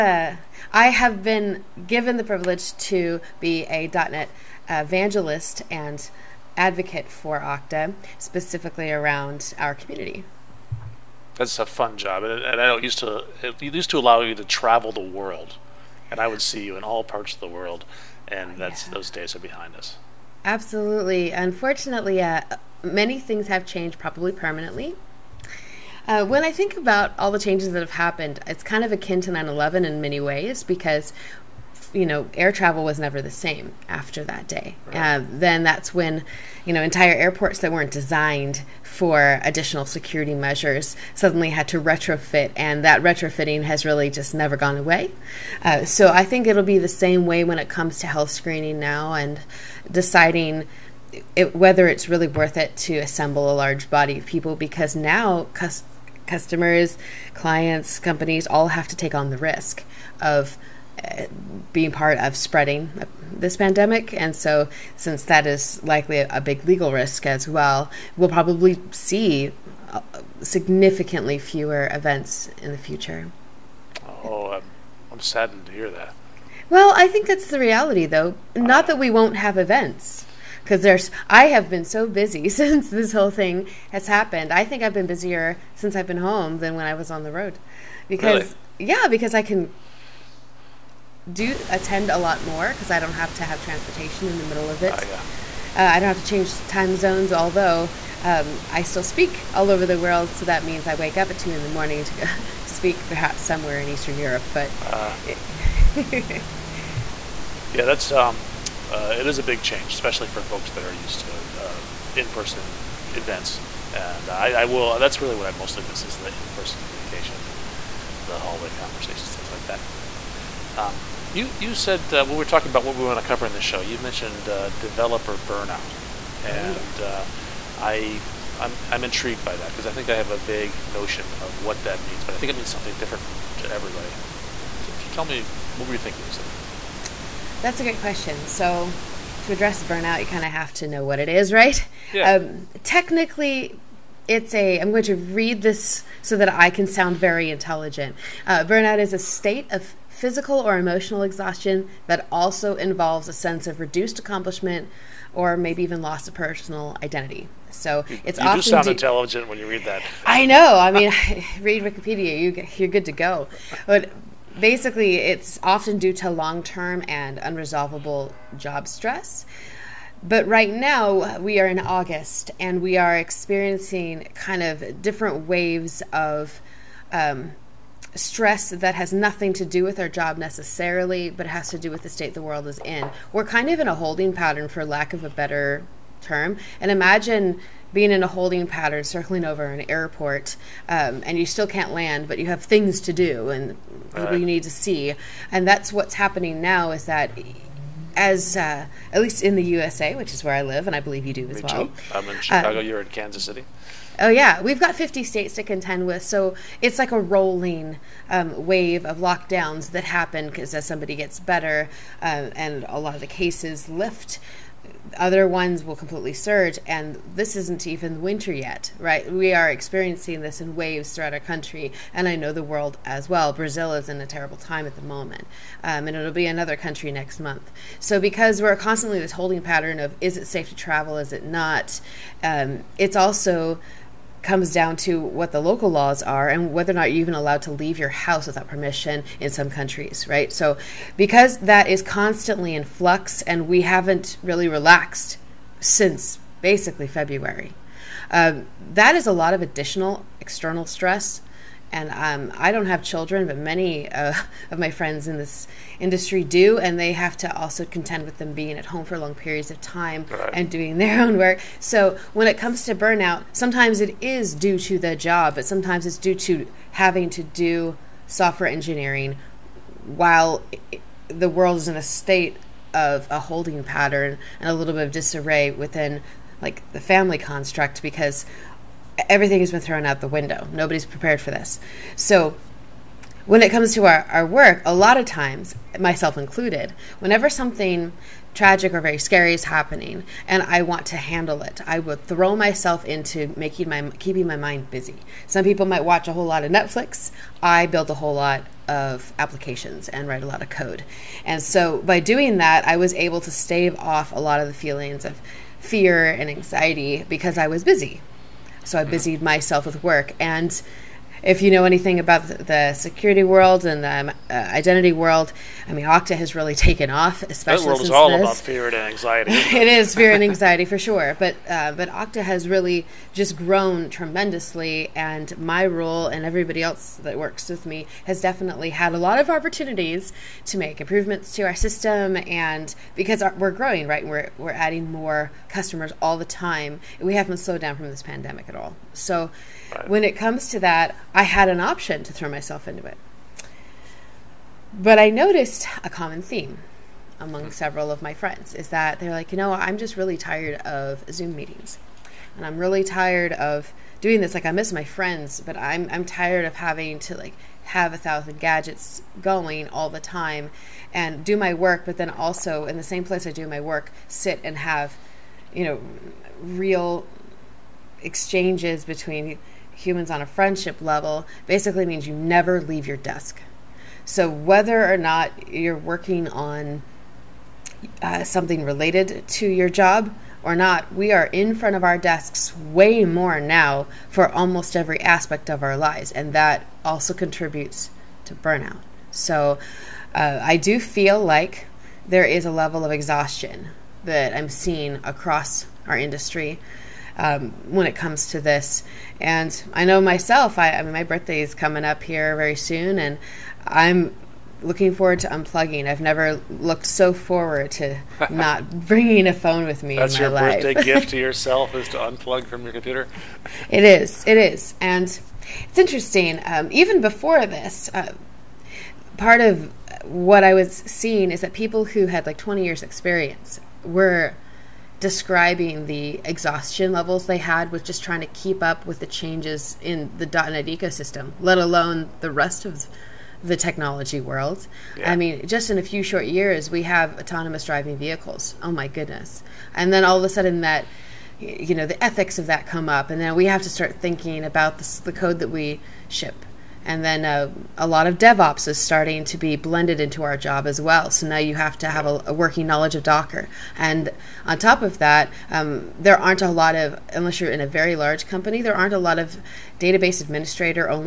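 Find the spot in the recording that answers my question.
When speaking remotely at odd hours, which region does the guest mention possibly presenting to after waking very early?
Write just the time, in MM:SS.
01:43.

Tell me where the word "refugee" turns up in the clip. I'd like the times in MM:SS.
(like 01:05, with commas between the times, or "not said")
not said.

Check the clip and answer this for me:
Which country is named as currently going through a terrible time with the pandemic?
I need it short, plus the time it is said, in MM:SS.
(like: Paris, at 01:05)
Brazil, at 03:43.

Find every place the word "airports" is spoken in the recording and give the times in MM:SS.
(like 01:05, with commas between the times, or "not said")
00:37, 03:09.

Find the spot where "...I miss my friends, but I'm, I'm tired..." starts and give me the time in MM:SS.
05:54.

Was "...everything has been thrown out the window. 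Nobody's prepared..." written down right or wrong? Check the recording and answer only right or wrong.
right.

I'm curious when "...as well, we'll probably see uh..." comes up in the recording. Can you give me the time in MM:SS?
01:07.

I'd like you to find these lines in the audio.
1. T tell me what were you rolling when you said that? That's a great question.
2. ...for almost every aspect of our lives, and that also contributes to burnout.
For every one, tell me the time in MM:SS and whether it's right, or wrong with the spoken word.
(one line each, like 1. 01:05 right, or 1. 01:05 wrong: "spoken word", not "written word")
1. 02:14 wrong: "thinking", not "rolling"
2. 06:24 right.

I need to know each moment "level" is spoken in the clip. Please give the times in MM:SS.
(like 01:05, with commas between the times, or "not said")
06:11, 06:32, 07:07.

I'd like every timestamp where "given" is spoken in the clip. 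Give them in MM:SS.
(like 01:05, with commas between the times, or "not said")
00:01.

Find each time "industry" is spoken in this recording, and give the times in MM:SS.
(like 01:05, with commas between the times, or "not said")
04:15, 06:36.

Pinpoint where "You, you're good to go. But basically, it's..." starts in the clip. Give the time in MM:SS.
02:42.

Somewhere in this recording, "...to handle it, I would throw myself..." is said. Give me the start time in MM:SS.
04:51.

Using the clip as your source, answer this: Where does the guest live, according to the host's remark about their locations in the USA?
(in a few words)
Kansas City.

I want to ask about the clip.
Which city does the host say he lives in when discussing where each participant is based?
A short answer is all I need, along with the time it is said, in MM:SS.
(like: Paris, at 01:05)
Chicago, at 03:22.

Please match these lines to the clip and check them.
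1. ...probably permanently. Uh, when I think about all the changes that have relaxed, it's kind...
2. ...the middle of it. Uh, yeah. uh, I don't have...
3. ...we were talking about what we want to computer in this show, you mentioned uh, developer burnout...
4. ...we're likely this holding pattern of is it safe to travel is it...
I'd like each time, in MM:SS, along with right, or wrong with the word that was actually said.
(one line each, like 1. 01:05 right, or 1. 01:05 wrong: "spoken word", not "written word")
1. 00:23 wrong: "happened", not "relaxed"
2. 01:34 right
3. 02:02 wrong: "cover", not "computer"
4. 03:48 wrong: "constantly", not "likely".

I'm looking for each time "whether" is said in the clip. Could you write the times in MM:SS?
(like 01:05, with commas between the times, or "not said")
00:51, 03:56, 06:14.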